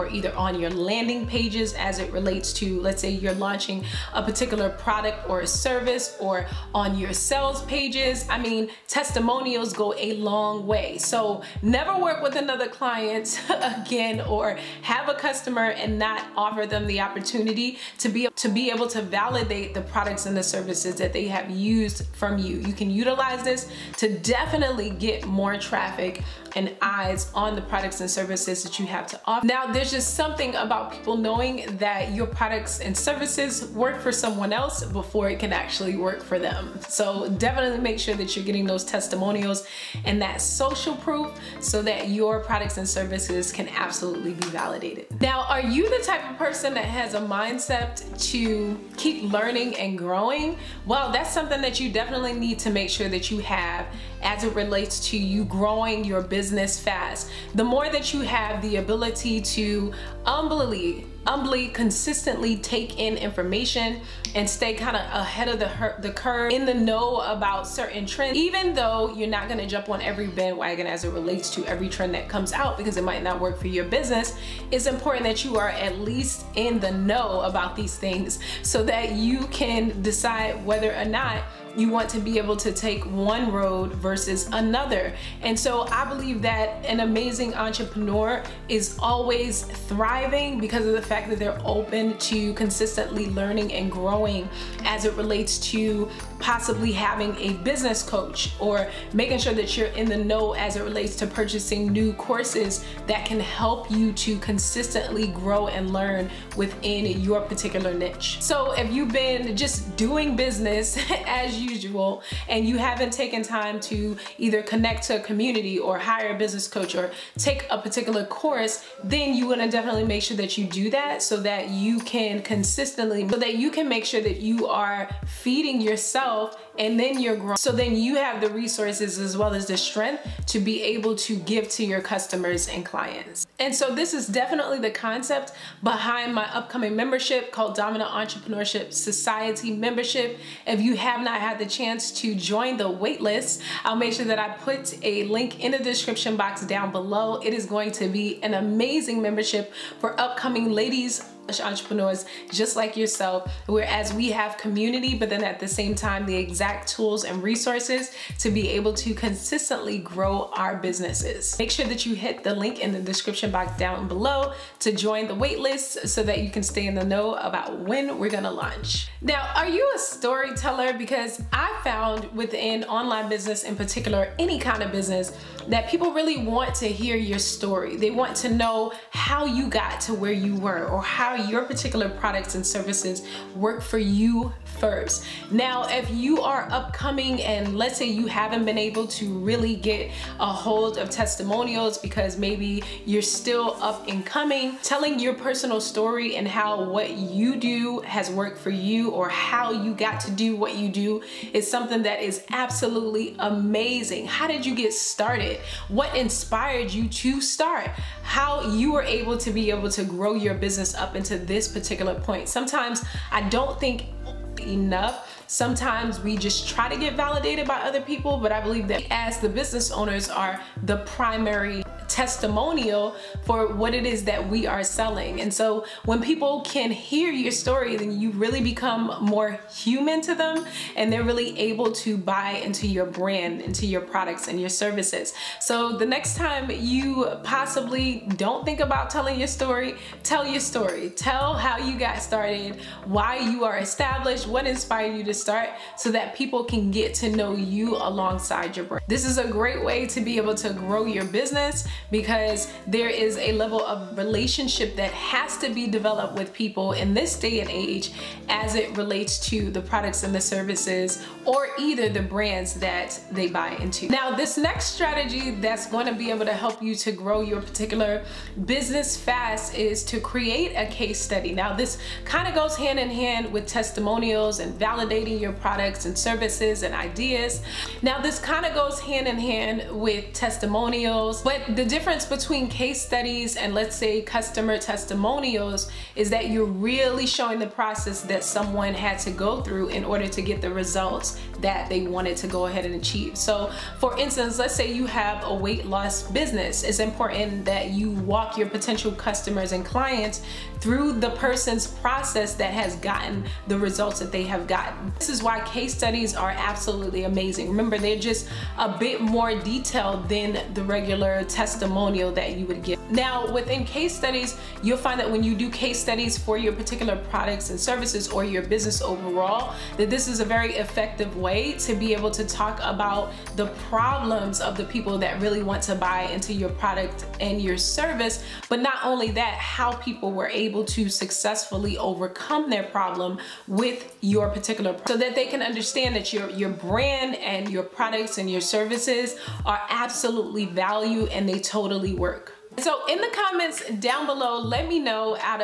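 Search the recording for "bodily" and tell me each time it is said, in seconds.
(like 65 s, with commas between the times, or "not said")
not said.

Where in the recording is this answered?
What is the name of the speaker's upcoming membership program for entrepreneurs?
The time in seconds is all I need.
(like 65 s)
137 s.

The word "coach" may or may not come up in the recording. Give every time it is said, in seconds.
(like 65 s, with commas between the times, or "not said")
98 s, 116 s.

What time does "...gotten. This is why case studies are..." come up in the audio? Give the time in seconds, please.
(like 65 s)
304 s.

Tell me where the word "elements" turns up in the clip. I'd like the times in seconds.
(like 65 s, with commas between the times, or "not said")
not said.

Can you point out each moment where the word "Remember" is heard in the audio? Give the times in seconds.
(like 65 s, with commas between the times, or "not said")
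307 s.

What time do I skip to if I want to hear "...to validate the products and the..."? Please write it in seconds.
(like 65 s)
18 s.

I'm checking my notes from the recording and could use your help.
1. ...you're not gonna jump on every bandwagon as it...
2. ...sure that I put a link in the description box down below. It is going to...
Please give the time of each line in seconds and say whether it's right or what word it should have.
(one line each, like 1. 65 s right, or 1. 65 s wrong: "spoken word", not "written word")
1. 69 s right
2. 144 s right.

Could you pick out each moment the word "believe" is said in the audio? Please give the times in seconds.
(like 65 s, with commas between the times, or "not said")
86 s, 218 s.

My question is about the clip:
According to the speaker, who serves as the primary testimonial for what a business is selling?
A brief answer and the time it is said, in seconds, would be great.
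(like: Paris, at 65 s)
The business owners, at 219 s.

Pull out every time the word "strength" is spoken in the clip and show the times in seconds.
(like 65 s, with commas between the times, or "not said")
129 s.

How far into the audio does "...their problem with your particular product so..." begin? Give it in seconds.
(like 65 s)
332 s.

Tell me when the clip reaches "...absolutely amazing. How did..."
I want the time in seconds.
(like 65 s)
202 s.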